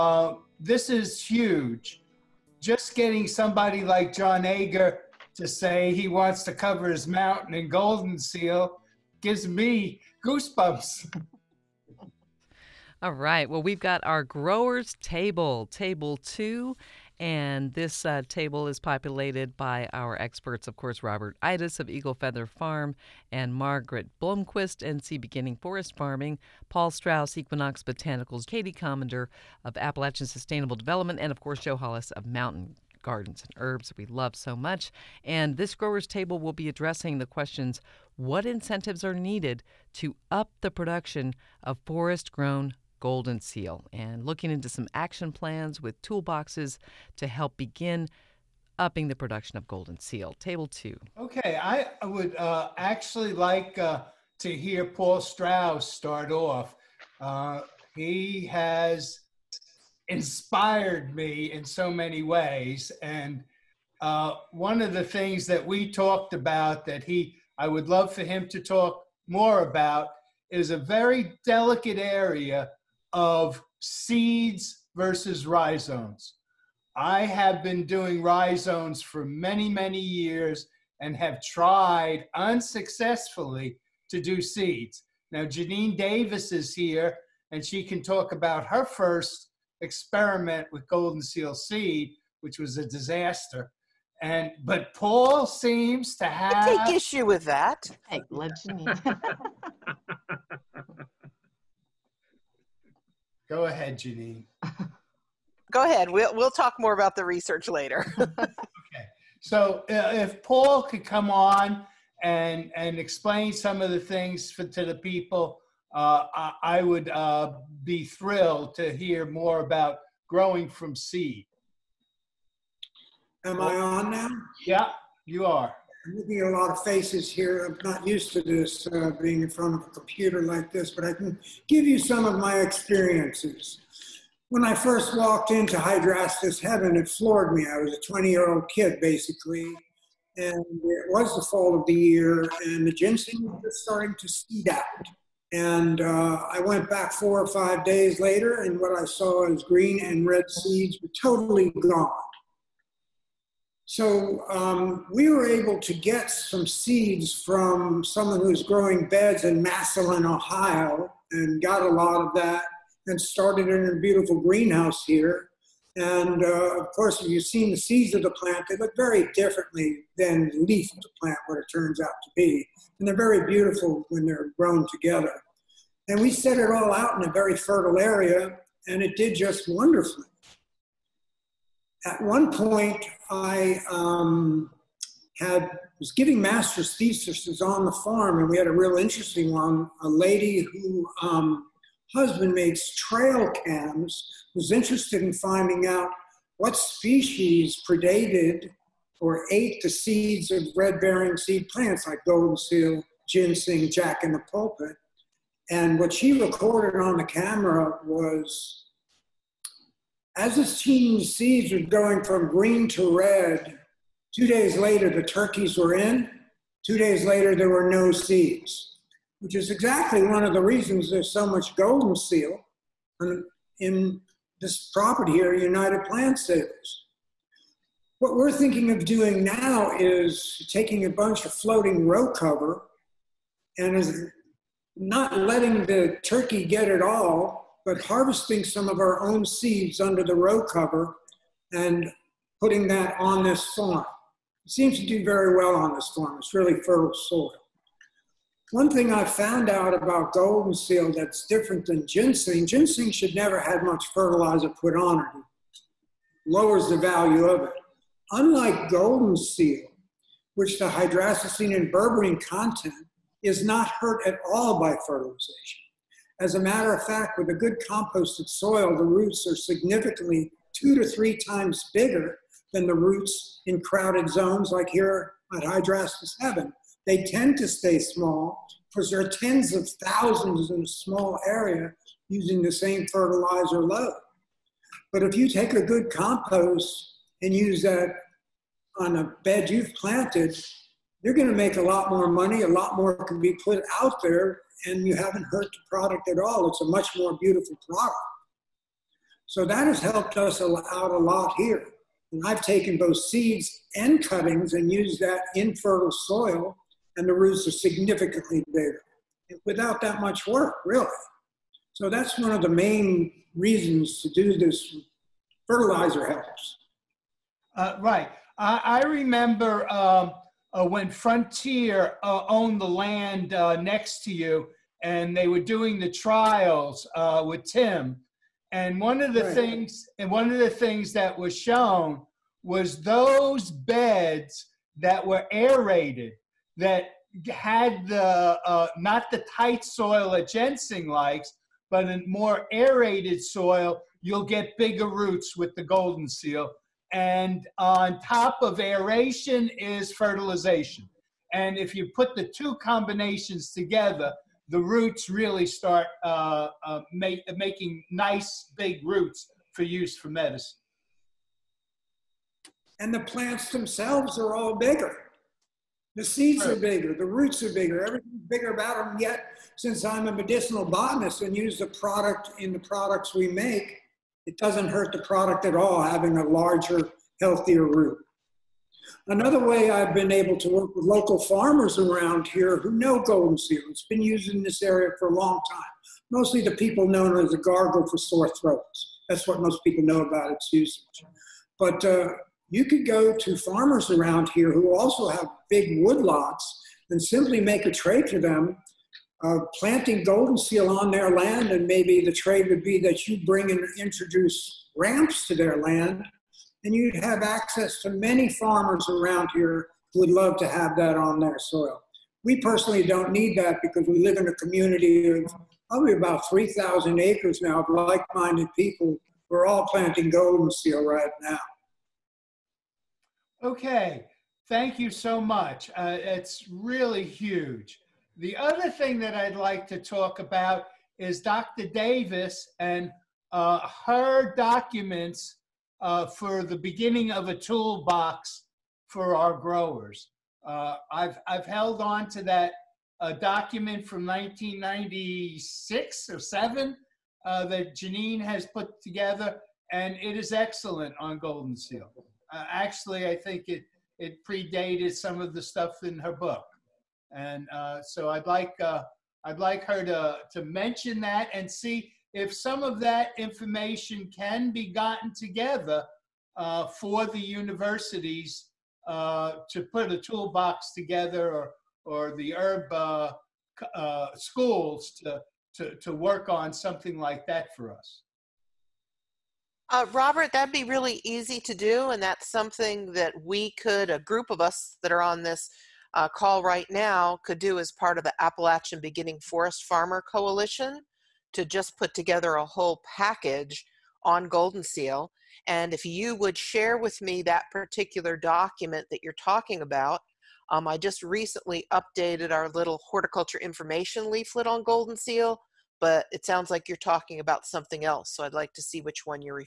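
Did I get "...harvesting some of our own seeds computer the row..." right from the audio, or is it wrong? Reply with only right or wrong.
wrong.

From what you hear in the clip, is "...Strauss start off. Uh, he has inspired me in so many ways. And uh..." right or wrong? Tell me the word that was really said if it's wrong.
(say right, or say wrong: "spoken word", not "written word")
right.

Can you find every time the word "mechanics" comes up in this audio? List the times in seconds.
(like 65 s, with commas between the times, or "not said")
not said.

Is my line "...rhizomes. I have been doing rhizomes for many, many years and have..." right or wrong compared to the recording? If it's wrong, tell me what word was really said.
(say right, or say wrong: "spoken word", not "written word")
right.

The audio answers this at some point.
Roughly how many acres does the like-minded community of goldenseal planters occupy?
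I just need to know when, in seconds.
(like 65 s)
416 s.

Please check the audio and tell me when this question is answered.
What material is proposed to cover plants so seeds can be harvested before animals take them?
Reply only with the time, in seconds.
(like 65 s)
231 s.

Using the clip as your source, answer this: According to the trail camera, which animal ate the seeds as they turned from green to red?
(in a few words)
Turkeys.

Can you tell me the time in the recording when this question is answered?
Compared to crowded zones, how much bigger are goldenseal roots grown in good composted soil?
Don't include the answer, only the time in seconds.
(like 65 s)
270 s.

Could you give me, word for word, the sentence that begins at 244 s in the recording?
It seems to do very well on this farm.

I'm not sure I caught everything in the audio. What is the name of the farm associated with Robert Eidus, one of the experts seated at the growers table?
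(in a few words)
Eagle Feather Farm.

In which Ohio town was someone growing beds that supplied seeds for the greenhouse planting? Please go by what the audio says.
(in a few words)
Massillon.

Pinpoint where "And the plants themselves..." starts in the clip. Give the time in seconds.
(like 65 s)
362 s.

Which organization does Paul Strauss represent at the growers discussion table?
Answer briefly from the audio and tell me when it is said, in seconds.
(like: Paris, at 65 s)
Equinox Botanicals, at 27 s.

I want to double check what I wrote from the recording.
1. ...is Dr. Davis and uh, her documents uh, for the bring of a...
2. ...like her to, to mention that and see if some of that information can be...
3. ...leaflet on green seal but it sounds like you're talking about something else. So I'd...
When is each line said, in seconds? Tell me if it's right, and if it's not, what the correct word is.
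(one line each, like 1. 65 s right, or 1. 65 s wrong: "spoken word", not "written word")
1. 431 s wrong: "beginning", not "bring"
2. 459 s right
3. 504 s wrong: "golden", not "green".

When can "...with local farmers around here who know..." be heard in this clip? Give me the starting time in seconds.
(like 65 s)
380 s.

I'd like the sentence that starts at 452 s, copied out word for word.
Uh, actually, I think it, it predated some of the stuff in her book.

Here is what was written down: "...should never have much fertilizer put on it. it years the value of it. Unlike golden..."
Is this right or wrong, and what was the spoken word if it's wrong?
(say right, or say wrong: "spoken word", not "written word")
wrong: "lowers", not "years".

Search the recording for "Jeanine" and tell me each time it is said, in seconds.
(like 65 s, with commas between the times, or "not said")
85 s, 103 s, 447 s.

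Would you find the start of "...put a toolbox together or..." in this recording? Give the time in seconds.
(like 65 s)
469 s.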